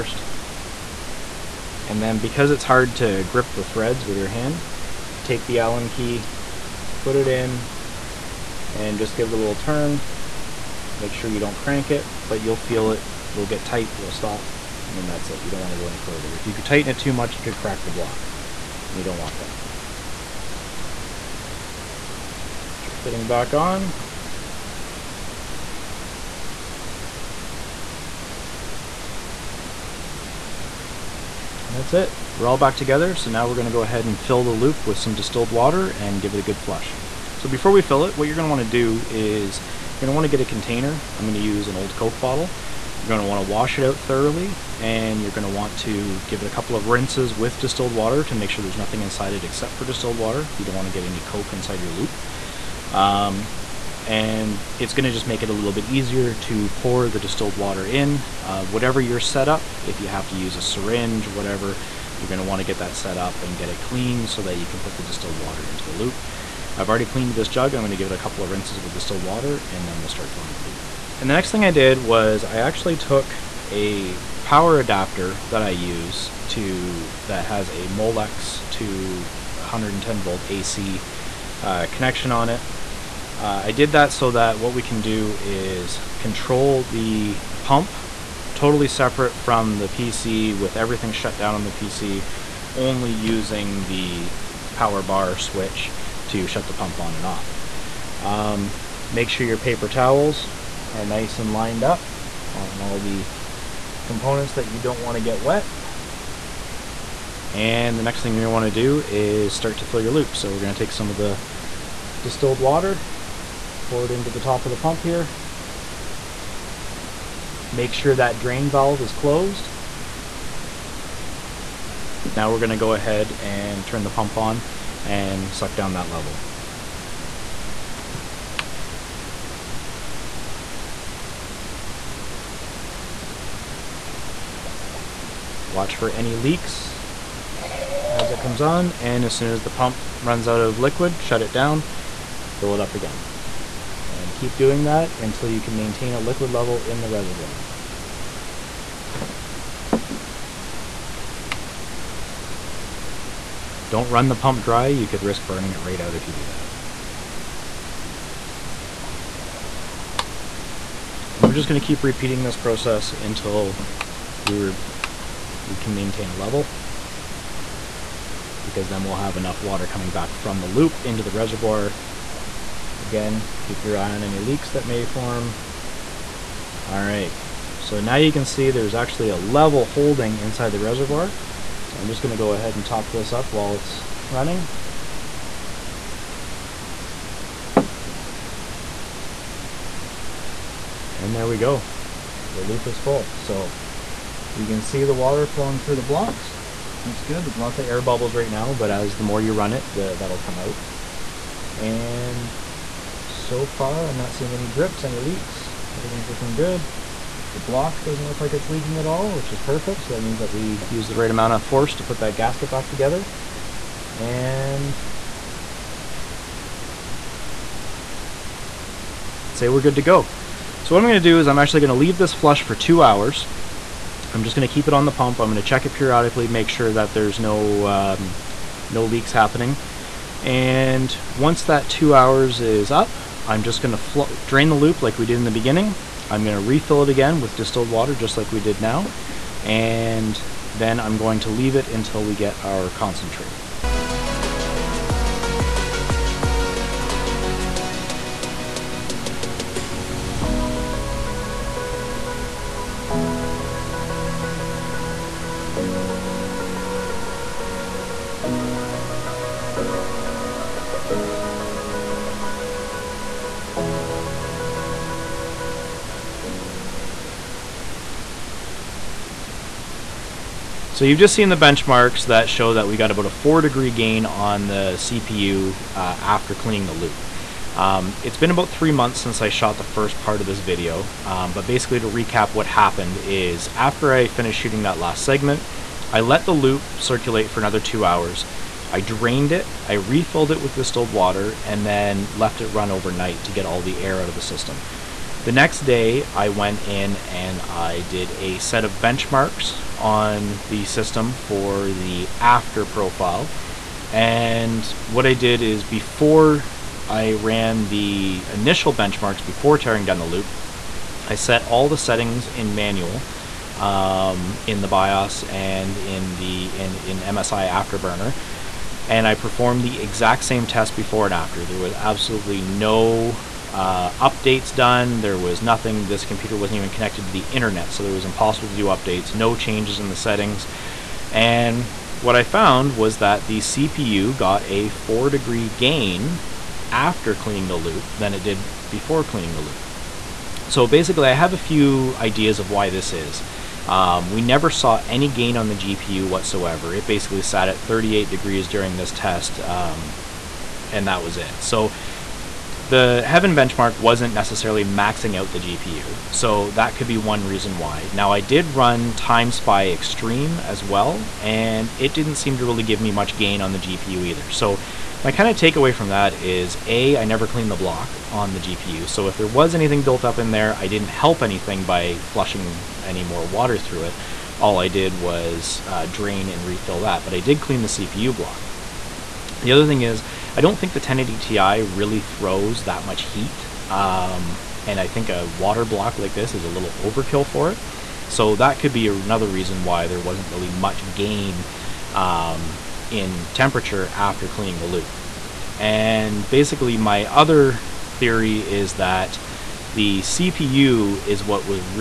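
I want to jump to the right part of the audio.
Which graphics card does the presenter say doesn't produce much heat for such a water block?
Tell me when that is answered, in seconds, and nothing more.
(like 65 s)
380 s.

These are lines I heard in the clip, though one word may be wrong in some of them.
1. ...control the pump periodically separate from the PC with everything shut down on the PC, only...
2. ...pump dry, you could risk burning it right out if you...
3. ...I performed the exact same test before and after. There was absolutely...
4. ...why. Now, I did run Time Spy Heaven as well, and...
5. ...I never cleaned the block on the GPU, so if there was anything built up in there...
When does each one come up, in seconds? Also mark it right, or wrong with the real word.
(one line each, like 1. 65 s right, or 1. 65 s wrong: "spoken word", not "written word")
1. 86 s wrong: "totally", not "periodically"
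2. 154 s right
3. 319 s right
4. 357 s wrong: "Extreme", not "Heaven"
5. 367 s right.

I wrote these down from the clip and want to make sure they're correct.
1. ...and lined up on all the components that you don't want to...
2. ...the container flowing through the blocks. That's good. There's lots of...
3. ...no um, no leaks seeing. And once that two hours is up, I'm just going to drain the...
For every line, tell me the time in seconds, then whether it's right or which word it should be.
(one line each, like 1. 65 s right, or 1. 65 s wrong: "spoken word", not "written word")
1. 101 s right
2. 195 s wrong: "water", not "container"
3. 227 s wrong: "happening", not "seeing".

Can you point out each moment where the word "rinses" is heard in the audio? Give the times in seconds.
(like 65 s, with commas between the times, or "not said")
46 s, 68 s.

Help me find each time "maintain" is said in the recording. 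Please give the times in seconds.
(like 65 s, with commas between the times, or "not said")
145 s, 165 s.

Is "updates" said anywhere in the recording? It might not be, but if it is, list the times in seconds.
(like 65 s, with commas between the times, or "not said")
324 s, 328 s.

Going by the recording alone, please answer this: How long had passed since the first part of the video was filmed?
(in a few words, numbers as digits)
3 months.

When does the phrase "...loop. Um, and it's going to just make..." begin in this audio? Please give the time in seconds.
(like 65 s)
51 s.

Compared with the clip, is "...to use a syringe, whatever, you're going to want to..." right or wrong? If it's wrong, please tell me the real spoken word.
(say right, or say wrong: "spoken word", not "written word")
right.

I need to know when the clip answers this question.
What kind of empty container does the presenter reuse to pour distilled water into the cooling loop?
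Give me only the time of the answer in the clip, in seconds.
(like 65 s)
41 s.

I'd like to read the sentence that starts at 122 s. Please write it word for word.
Now we're going to go ahead and turn the pump on and suck down that level.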